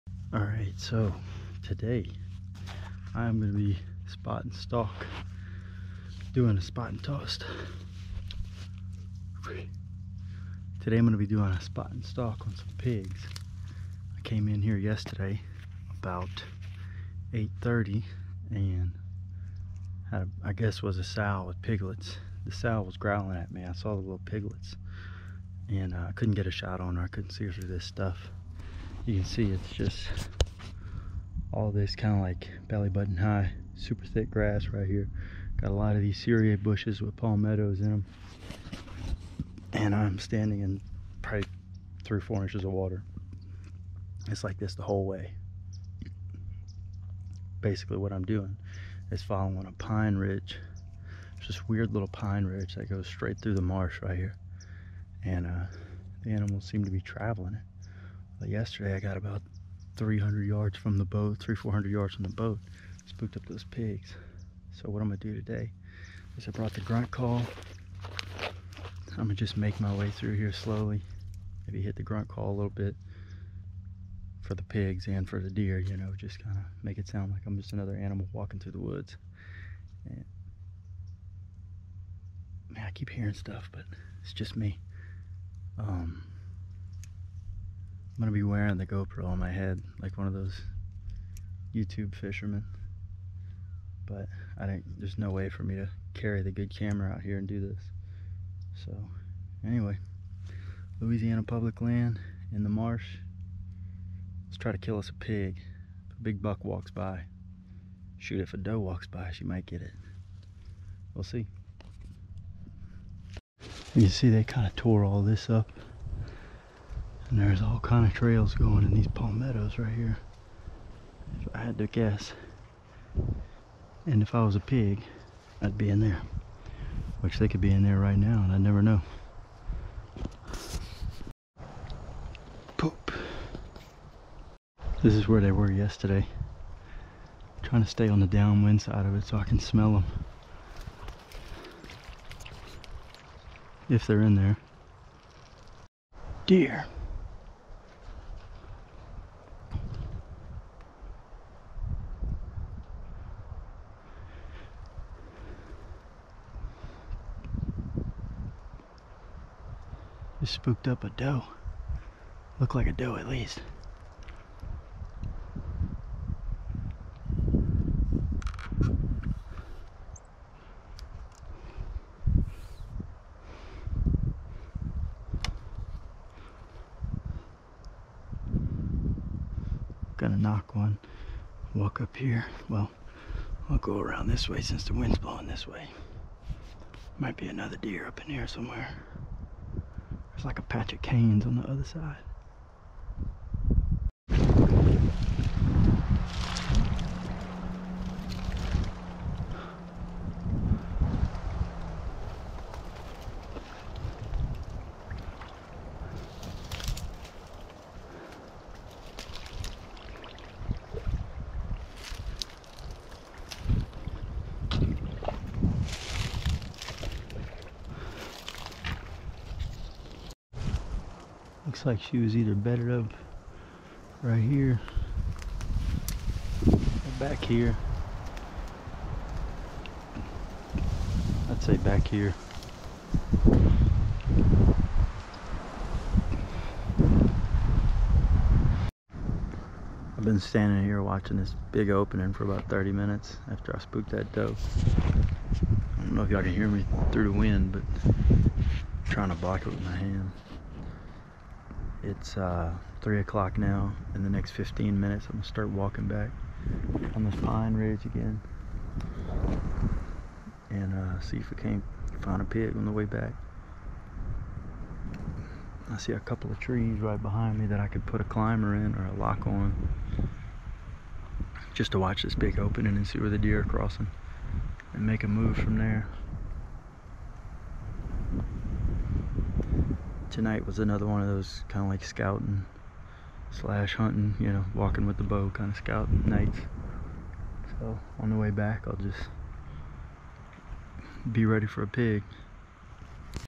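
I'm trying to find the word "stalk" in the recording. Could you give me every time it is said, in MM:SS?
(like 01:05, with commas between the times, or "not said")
00:04, 00:12.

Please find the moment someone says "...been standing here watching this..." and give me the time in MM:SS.
04:00.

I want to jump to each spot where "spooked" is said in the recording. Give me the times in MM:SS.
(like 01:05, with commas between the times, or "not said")
01:03, 02:40, 04:03.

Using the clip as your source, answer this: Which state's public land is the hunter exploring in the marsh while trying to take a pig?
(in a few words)
Louisiana.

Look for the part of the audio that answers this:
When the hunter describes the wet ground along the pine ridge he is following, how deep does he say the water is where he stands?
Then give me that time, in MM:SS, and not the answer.
00:42.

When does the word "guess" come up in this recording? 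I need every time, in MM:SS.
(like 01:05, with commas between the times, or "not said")
00:20, 02:01.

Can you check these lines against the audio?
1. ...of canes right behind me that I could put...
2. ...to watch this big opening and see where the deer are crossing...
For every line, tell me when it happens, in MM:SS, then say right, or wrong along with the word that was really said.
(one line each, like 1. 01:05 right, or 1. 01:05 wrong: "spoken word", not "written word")
1. 04:26 wrong: "trees", not "canes"
2. 04:31 right.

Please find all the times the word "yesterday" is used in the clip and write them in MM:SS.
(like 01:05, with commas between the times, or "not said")
00:14, 00:58, 02:15.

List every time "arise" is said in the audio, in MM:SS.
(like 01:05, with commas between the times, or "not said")
not said.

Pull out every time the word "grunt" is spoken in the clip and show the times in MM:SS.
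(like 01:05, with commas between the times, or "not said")
01:06, 01:12.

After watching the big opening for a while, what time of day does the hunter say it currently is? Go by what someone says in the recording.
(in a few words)
3 o'clock.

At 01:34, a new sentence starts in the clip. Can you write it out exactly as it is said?
But I didn't, there's no way for me to carry the good camera out here and do this.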